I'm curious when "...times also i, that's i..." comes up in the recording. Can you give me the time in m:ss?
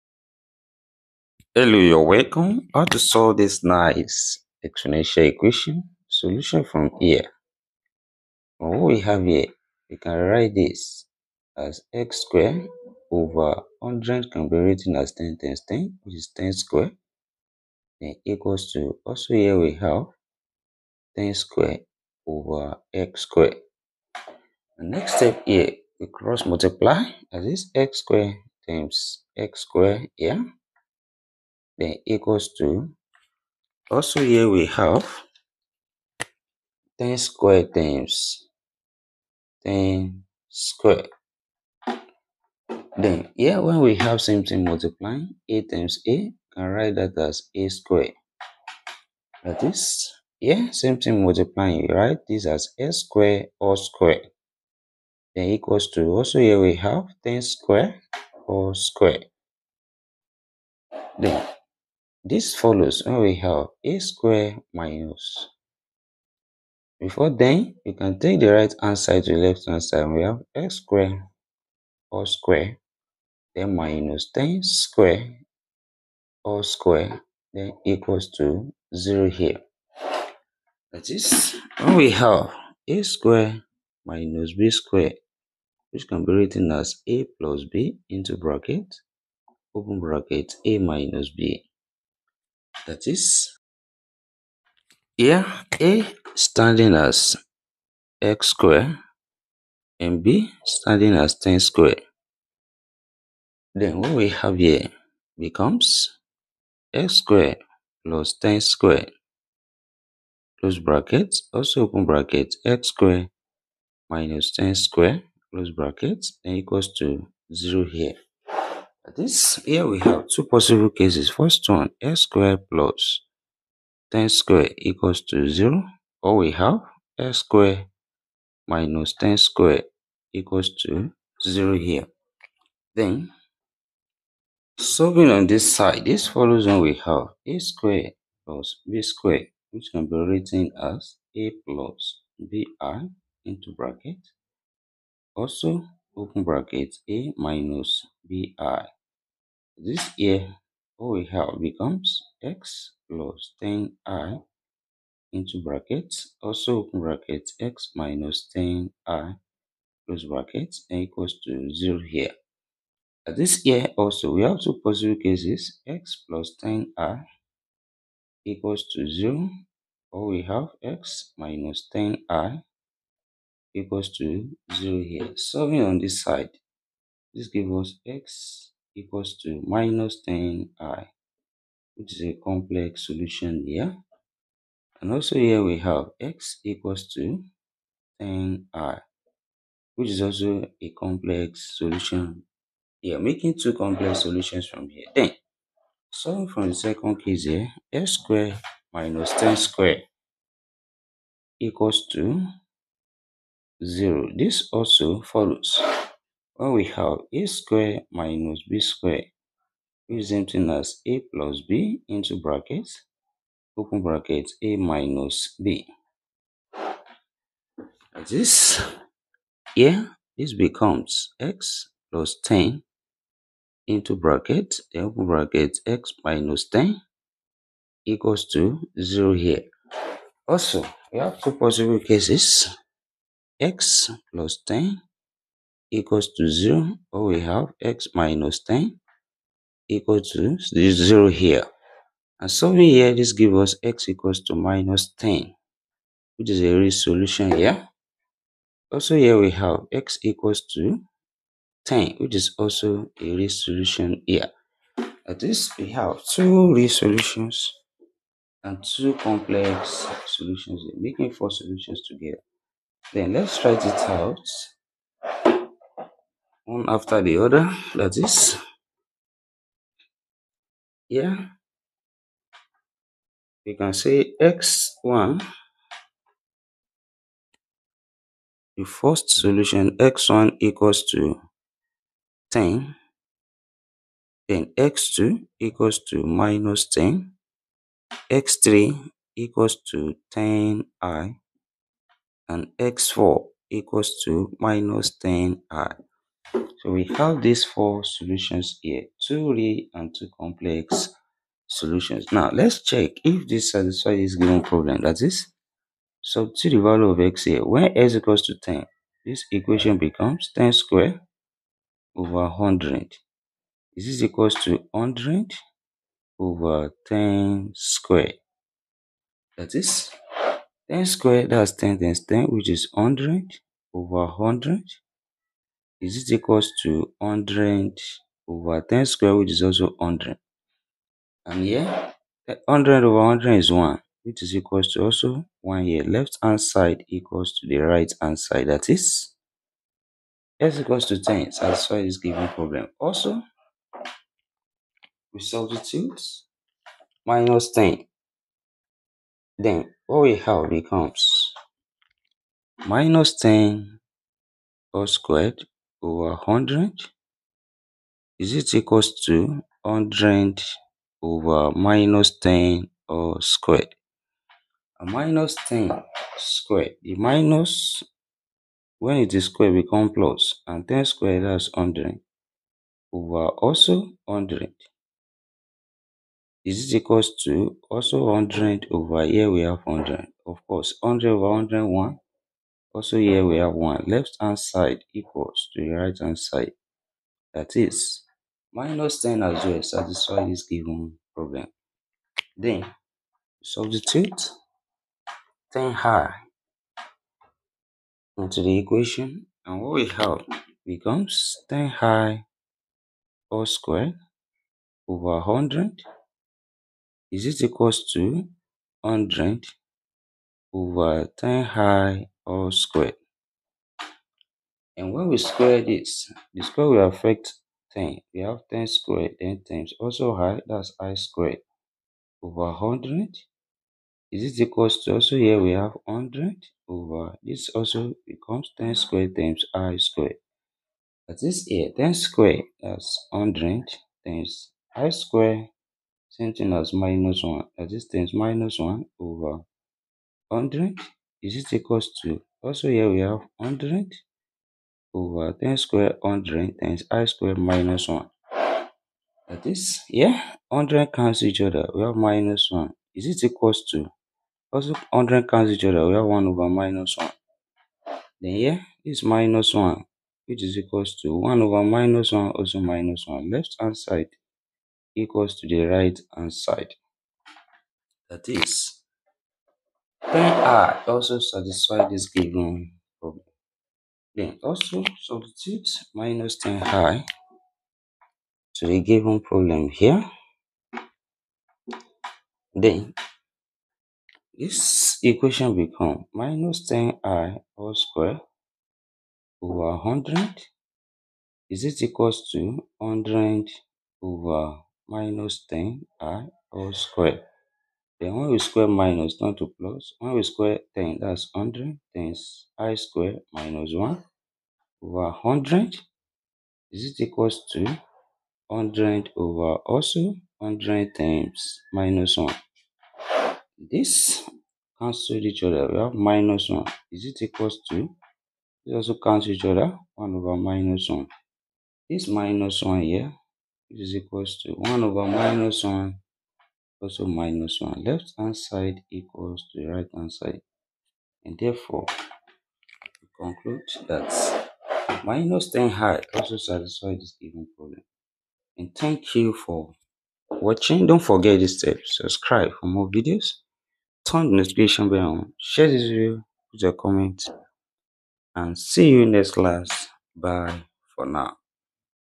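6:59.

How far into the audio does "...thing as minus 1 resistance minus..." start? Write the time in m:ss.
7:16.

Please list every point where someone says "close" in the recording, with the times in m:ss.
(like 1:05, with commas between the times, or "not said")
1:50, 1:55, 2:40.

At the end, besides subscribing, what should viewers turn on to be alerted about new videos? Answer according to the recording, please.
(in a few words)
notification bell.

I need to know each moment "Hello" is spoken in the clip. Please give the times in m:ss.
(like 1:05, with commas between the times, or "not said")
0:01.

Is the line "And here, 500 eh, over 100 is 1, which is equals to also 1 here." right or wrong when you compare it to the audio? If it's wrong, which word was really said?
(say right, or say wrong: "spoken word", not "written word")
wrong: "100", not "500".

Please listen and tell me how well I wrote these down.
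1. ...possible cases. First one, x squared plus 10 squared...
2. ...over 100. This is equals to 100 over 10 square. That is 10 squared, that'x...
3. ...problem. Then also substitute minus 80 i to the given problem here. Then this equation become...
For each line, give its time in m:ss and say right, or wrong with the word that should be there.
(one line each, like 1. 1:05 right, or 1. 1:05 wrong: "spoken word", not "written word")
1. 2:00 right
2. 5:12 right
3. 7:53 wrong: "10", not "80".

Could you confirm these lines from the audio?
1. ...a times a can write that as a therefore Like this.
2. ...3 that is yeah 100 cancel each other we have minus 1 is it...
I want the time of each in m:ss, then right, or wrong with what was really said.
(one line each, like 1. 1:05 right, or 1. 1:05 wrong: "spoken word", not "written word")
1. 0:45 wrong: "square", not "therefore"
2. 7:28 wrong: "1", not "3".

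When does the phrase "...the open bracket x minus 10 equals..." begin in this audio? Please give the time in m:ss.
3:44.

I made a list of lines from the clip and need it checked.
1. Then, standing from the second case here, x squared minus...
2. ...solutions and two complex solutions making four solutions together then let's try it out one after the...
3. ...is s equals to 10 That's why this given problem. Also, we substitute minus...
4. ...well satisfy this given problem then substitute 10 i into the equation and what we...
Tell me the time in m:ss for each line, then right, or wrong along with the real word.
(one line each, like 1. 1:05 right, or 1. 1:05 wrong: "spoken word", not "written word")
1. 3:15 wrong: "solving", not "standing"
2. 4:16 right
3. 5:38 right
4. 6:29 right.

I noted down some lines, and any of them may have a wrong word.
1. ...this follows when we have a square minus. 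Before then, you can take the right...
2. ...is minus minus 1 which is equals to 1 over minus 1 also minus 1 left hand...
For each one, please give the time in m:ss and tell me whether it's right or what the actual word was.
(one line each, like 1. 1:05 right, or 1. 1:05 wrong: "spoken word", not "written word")
1. 1:02 right
2. 7:39 right.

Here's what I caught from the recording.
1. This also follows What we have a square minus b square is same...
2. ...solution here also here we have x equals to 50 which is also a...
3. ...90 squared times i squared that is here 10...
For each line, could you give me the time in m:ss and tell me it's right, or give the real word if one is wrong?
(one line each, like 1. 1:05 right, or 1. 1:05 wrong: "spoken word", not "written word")
1. 3:24 right
2. 4:06 wrong: "10", not "50"
3. 7:08 wrong: "10", not "90".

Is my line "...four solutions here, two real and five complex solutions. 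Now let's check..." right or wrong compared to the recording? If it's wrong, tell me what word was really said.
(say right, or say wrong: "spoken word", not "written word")
wrong: "two", not "five".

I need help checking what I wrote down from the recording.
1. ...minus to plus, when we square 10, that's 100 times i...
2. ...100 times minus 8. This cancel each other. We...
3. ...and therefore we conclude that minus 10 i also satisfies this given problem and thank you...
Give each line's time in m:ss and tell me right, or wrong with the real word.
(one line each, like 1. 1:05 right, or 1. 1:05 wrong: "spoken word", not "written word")
1. 8:18 right
2. 8:30 wrong: "1", not "8"
3. 8:51 right.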